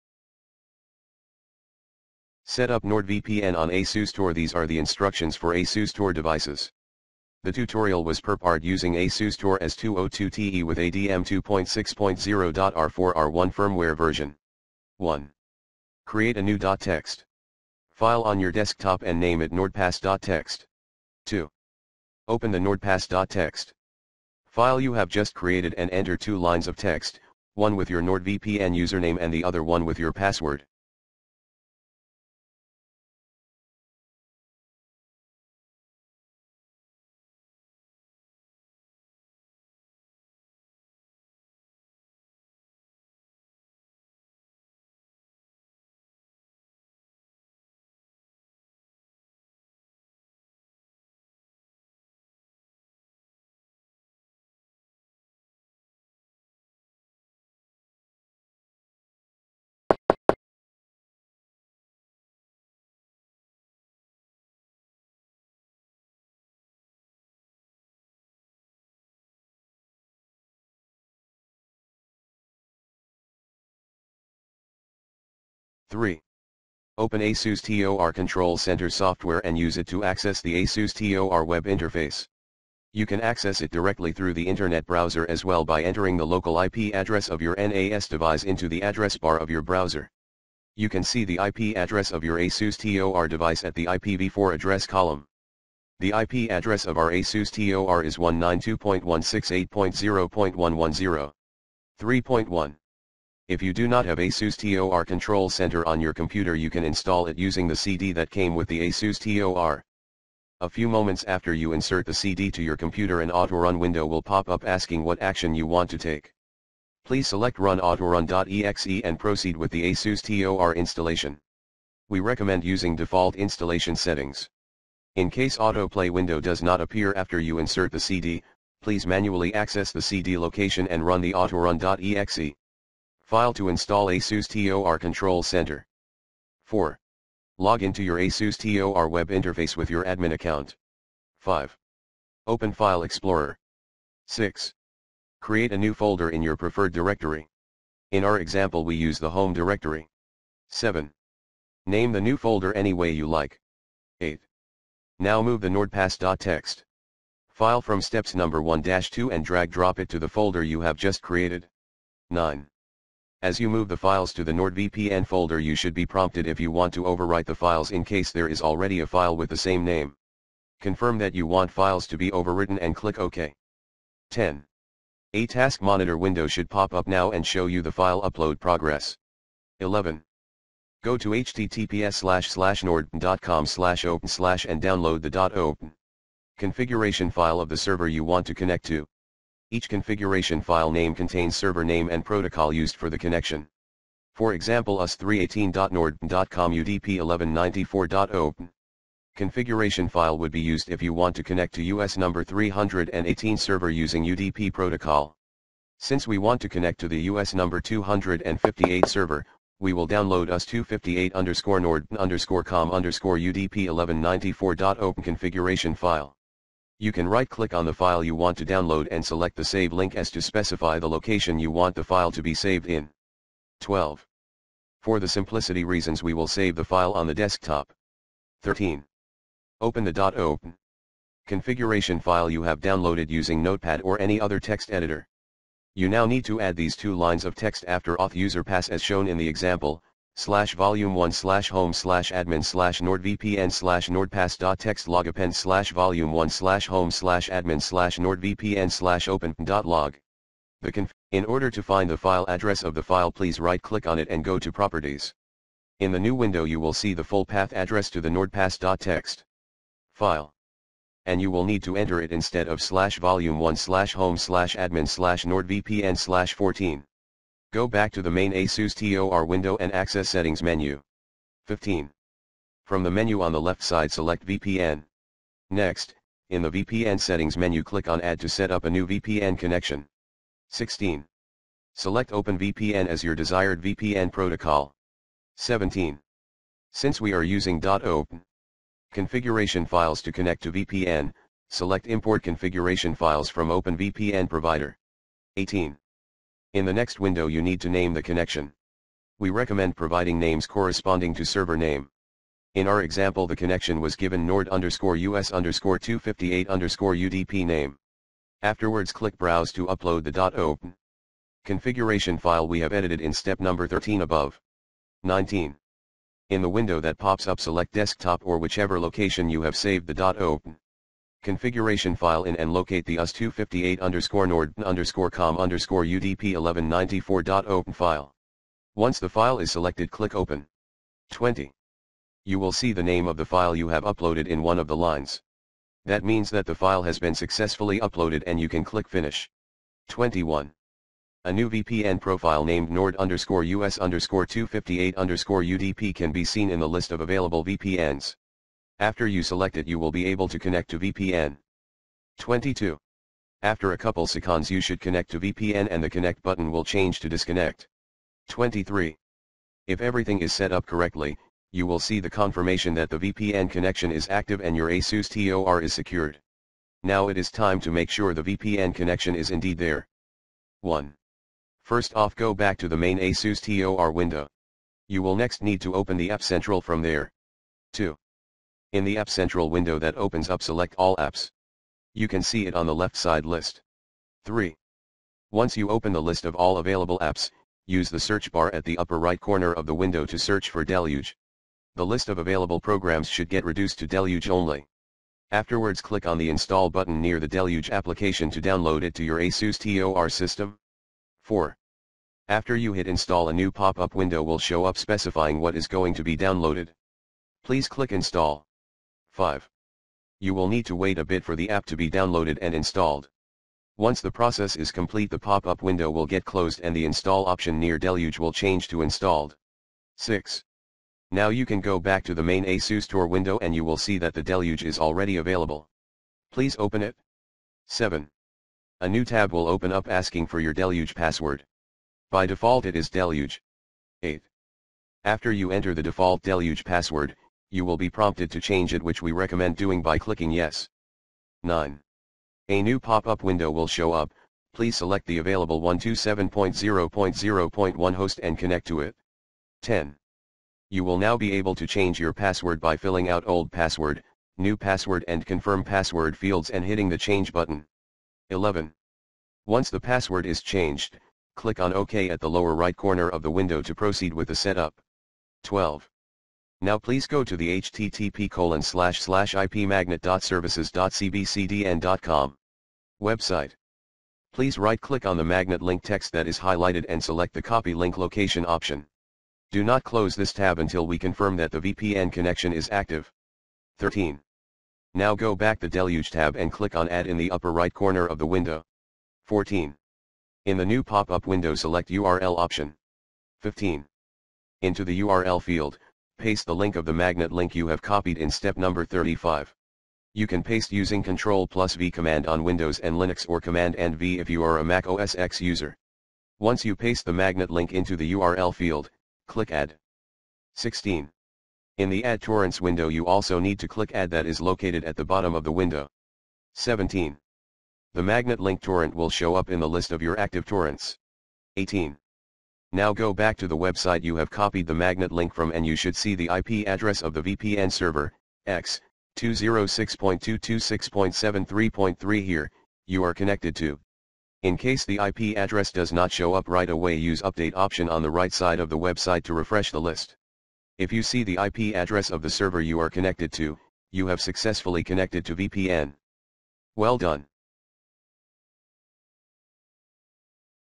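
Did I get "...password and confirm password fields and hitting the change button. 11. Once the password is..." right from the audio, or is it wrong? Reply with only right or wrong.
right.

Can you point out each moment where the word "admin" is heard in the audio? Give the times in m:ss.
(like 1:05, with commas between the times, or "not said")
2:20, 4:02, 4:07, 4:24.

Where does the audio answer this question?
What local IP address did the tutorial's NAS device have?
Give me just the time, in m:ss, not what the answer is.
1:38.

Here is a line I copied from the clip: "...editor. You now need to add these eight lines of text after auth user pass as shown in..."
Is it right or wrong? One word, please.
wrong.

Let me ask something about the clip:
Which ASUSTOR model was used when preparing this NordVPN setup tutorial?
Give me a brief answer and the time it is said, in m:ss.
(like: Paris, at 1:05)
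S202TE, at 0:08.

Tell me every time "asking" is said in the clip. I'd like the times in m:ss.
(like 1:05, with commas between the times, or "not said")
1:54, 7:10.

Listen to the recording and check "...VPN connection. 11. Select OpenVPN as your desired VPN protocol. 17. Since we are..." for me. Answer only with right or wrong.
wrong.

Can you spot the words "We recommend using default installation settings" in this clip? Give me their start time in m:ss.
2:02.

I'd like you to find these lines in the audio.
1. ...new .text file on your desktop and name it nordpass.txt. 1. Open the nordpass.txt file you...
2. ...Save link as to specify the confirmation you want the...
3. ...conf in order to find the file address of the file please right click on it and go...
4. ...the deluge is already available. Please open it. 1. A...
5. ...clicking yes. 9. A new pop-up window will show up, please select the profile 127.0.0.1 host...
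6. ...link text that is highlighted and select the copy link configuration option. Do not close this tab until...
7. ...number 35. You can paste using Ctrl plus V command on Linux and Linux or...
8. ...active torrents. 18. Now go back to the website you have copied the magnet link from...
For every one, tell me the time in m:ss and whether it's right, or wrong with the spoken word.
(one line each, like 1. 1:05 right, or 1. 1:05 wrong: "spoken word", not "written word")
1. 0:16 wrong: "2", not "1"
2. 3:39 wrong: "location", not "confirmation"
3. 4:10 right
4. 7:04 wrong: "7", not "1"
5. 7:20 wrong: "available", not "profile"
6. 7:55 wrong: "location", not "configuration"
7. 8:18 wrong: "Windows", not "Linux"
8. 8:40 right.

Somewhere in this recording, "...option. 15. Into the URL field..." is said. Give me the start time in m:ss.
8:12.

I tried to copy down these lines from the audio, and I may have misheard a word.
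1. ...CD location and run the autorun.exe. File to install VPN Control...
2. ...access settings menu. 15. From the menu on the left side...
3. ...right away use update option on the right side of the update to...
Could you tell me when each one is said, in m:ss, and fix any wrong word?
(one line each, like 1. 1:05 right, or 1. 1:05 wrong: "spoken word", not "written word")
1. 2:10 wrong: "ASUSTOR", not "VPN"
2. 4:29 right
3. 8:56 wrong: "website", not "update".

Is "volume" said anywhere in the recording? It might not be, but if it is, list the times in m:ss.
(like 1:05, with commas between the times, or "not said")
4:00, 4:05, 4:23.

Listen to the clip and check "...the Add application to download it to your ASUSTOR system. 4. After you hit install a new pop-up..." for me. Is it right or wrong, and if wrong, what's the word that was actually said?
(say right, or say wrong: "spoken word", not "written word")
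wrong: "Deluge", not "Add".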